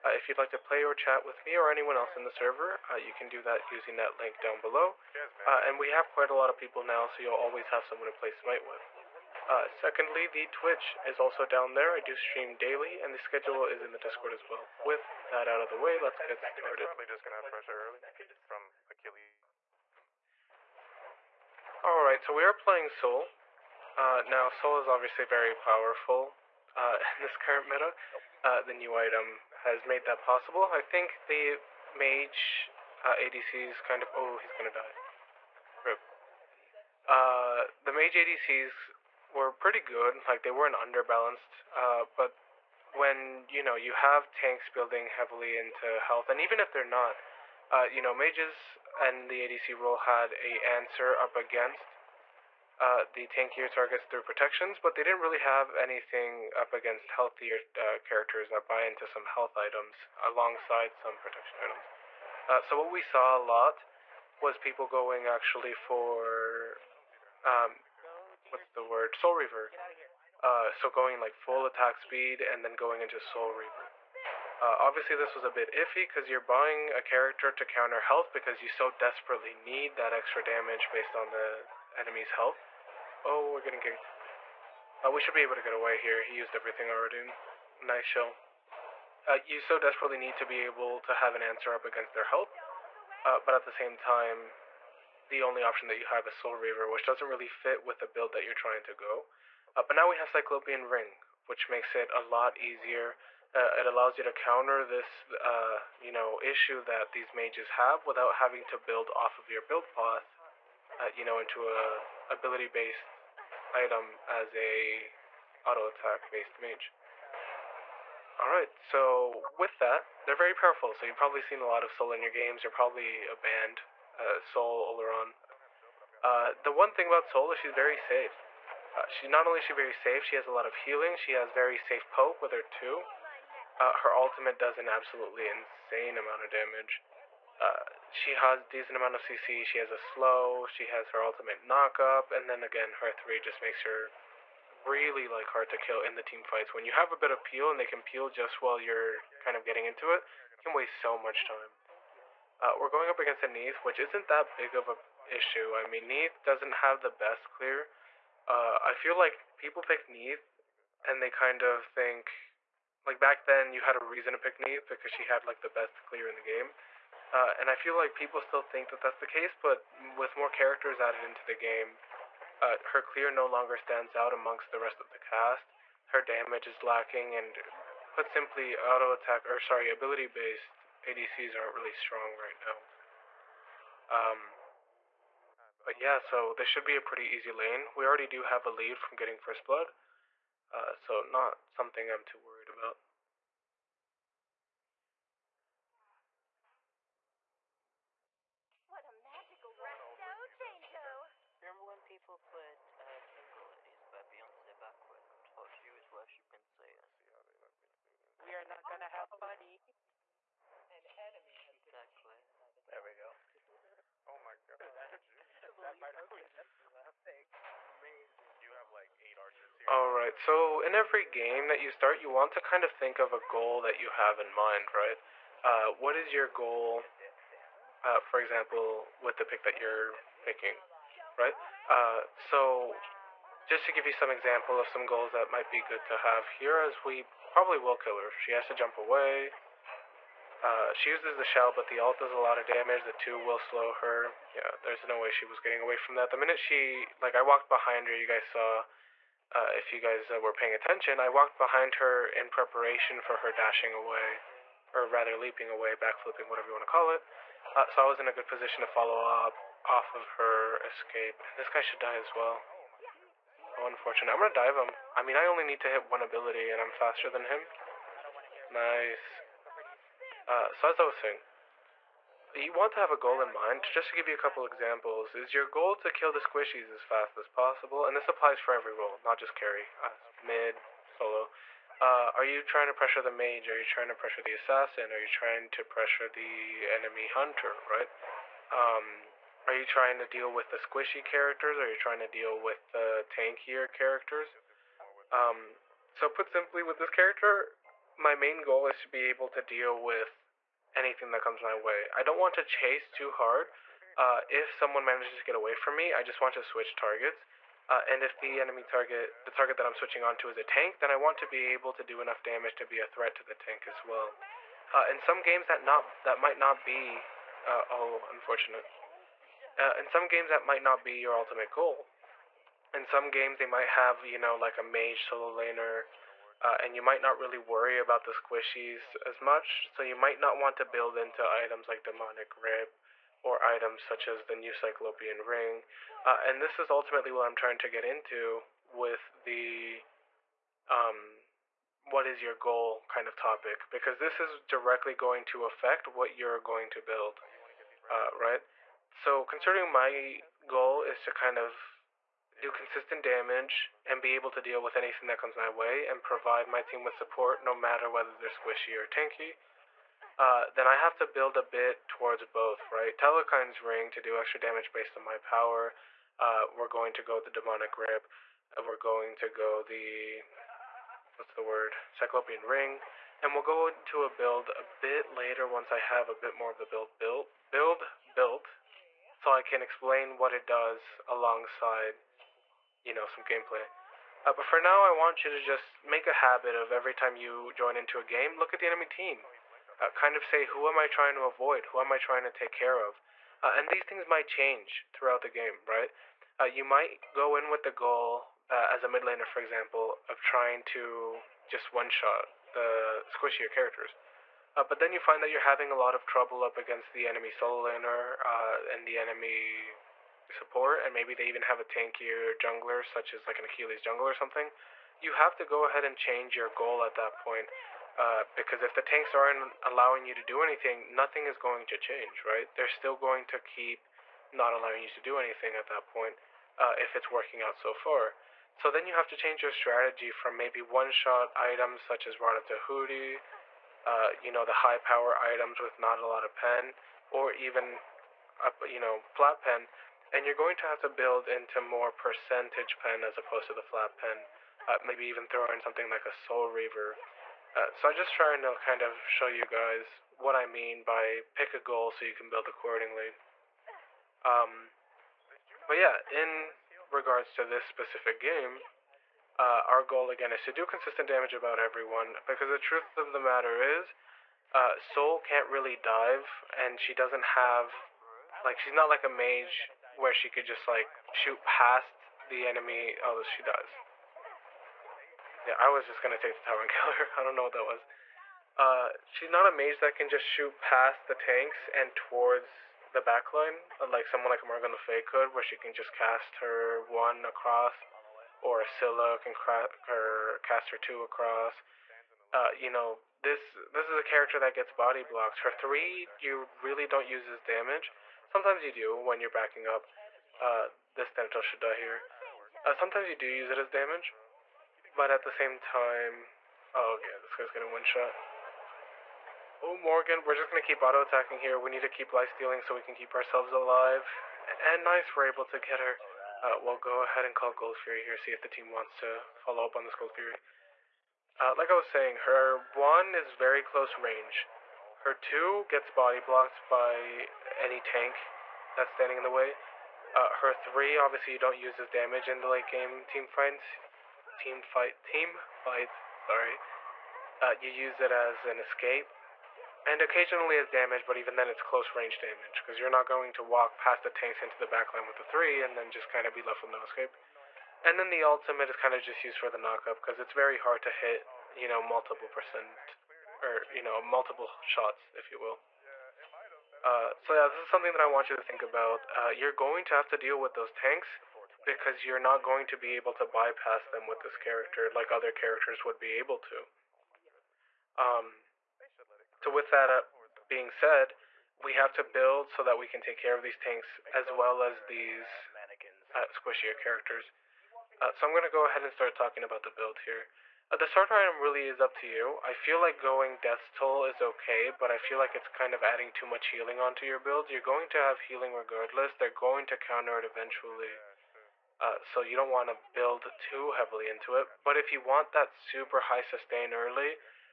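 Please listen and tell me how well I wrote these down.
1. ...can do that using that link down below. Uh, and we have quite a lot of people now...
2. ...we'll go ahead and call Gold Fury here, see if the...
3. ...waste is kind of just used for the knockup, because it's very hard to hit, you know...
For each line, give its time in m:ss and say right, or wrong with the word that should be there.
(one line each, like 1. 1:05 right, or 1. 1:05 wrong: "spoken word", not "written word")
1. 0:03 right
2. 8:36 right
3. 9:08 wrong: "ultimate", not "waste".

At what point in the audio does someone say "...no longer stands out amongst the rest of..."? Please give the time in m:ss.
2:53.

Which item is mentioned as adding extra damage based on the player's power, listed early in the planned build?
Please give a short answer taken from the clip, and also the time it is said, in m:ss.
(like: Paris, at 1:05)
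Telkhines Ring, at 6:03.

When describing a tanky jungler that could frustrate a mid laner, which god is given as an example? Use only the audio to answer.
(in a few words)
Achilles.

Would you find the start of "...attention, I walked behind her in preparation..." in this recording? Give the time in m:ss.
4:10.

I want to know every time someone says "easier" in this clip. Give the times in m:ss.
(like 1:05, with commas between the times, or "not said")
1:42.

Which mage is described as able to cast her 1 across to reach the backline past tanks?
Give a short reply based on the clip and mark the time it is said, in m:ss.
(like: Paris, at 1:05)
Morgan Le Fay, at 8:04.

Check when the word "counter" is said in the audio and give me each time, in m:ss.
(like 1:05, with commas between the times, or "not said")
1:17, 1:44, 9:49.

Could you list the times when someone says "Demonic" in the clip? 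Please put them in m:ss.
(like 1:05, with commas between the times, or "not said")
5:32, 6:07.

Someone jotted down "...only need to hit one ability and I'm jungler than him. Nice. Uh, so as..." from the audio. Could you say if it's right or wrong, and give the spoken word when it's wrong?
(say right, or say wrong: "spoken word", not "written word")
wrong: "faster", not "jungler".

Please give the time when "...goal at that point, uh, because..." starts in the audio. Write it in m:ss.
6:56.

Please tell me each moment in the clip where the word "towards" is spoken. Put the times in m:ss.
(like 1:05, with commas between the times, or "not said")
6:02, 8:02.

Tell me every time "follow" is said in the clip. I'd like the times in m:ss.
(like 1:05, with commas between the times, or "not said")
4:18, 8:39.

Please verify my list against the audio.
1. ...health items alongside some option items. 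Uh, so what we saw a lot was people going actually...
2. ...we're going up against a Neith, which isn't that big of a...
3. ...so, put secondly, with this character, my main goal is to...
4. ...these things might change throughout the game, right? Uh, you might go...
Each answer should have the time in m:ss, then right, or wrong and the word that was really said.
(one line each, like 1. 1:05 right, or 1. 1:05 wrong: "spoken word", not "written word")
1. 0:59 wrong: "protection", not "option"
2. 2:32 right
3. 4:56 wrong: "simply", not "secondly"
4. 6:33 right.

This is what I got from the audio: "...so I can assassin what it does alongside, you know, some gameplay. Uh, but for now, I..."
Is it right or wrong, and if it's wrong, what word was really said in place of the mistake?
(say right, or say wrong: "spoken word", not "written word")
wrong: "explain", not "assassin".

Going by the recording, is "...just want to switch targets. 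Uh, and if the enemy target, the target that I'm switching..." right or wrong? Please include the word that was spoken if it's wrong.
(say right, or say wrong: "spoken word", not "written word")
right.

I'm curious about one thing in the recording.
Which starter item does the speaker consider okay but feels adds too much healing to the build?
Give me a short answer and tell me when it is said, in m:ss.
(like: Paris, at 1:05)
Death's Toll, at 9:43.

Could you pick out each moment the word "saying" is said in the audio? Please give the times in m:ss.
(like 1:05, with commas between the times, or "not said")
4:31, 8:42.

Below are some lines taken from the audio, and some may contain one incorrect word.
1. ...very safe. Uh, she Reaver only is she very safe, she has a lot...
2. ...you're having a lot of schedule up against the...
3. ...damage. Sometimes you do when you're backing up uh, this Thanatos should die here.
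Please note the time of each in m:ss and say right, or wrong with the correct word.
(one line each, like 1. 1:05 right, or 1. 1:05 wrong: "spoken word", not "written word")
1. 2:07 wrong: "Not", not "Reaver"
2. 6:45 wrong: "trouble", not "schedule"
3. 8:17 right.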